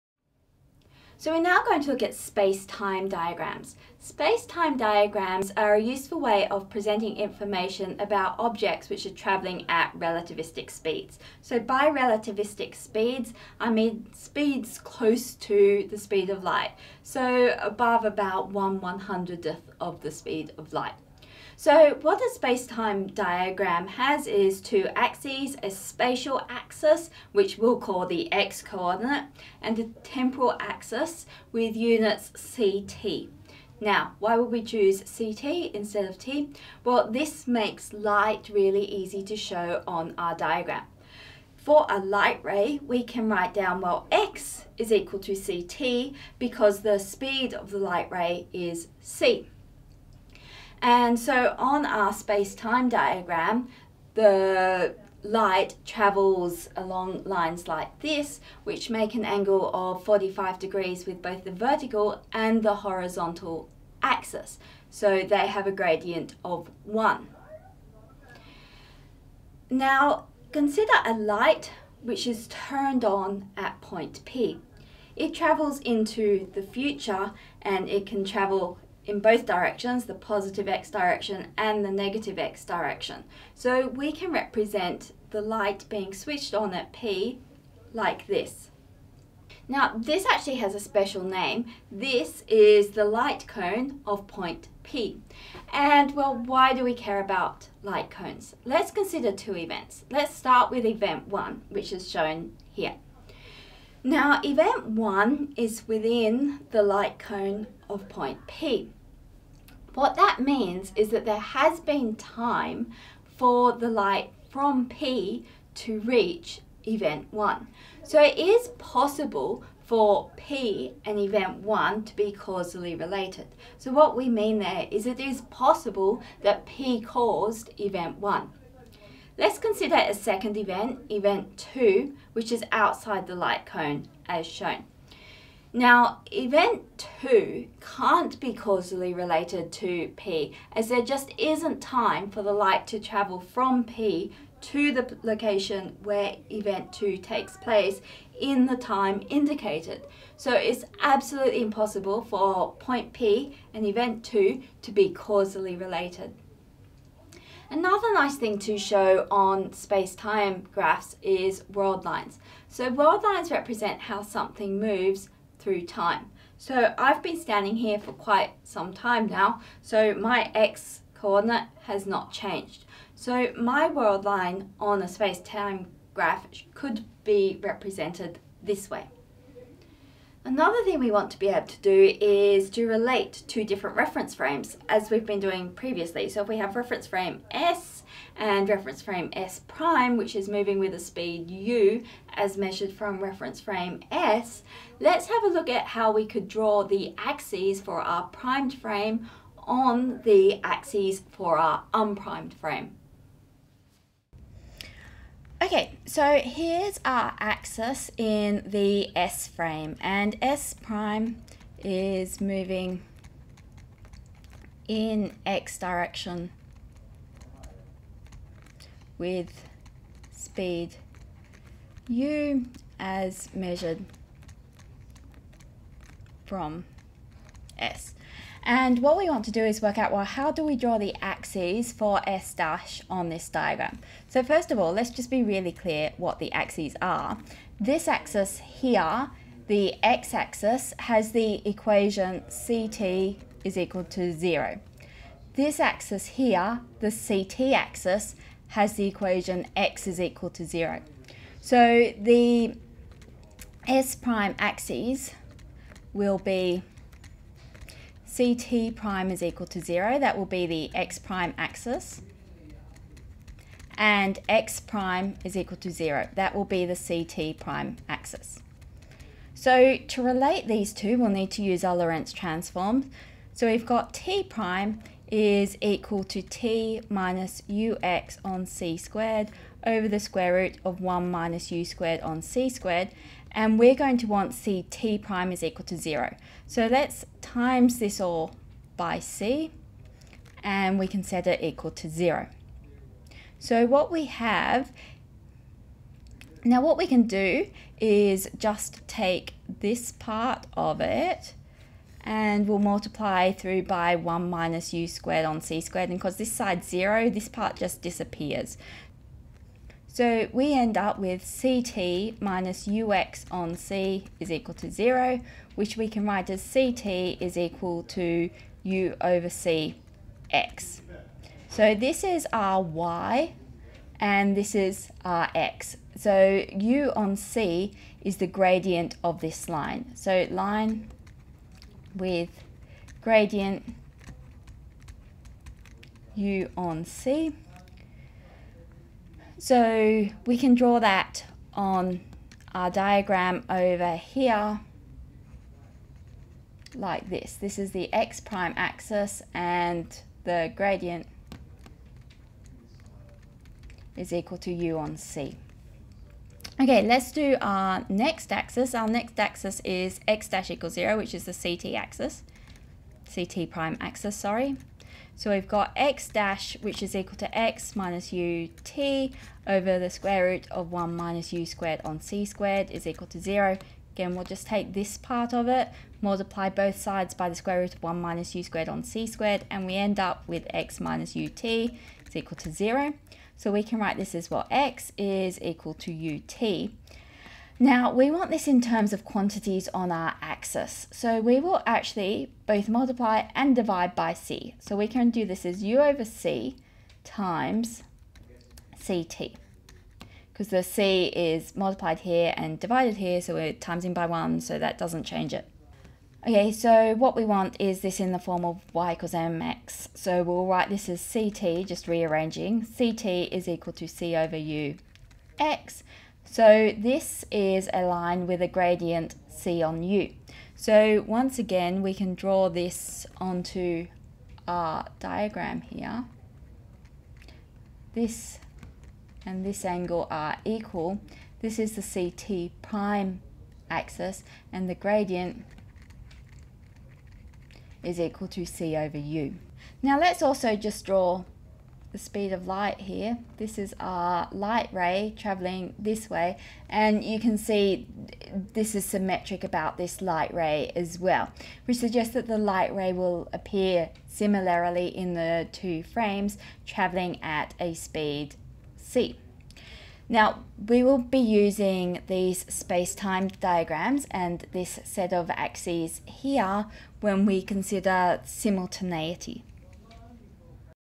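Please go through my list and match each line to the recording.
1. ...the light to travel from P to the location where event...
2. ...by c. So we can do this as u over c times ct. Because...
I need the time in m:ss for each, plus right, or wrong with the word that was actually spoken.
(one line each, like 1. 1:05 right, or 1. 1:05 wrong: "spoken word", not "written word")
1. 2:22 right
2. 6:34 right.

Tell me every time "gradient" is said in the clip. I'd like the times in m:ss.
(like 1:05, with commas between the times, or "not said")
1:05, 5:28, 5:33, 5:50, 6:58, 7:14.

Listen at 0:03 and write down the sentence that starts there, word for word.
Space-time diagrams are a useful way of presenting information about objects which are travelling at relativistic speeds.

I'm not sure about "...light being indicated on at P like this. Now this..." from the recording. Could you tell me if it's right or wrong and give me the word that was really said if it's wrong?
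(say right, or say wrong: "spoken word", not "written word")
wrong: "switched", not "indicated".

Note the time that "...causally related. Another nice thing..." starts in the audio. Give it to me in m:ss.
2:35.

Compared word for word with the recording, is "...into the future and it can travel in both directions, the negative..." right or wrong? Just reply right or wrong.
wrong.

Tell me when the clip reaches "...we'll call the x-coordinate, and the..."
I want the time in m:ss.
0:27.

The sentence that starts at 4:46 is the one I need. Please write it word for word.
So let's times this all by c and we can set it equal to 0.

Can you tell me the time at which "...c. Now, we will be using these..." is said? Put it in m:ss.
7:38.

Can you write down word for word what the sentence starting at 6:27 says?
Now we want this in terms of quantities on our axis.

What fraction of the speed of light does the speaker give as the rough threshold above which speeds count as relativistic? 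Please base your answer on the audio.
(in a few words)
1/100.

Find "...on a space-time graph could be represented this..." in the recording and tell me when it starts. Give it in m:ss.
2:54.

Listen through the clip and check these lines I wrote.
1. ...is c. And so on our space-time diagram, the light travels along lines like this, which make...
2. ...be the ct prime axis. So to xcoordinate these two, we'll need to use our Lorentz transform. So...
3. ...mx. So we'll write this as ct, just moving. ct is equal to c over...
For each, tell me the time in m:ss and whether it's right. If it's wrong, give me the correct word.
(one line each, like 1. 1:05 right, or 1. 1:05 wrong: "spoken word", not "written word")
1. 0:48 right
2. 4:26 wrong: "relate", not "xcoordinate"
3. 6:49 wrong: "rearranging", not "moving".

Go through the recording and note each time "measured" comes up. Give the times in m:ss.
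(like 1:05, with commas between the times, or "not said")
3:12, 3:43.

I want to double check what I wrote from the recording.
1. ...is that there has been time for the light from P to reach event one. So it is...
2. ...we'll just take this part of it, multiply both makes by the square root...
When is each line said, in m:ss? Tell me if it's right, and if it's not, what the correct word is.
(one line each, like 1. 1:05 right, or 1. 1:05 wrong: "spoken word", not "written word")
1. 1:50 right
2. 6:14 wrong: "sides", not "makes".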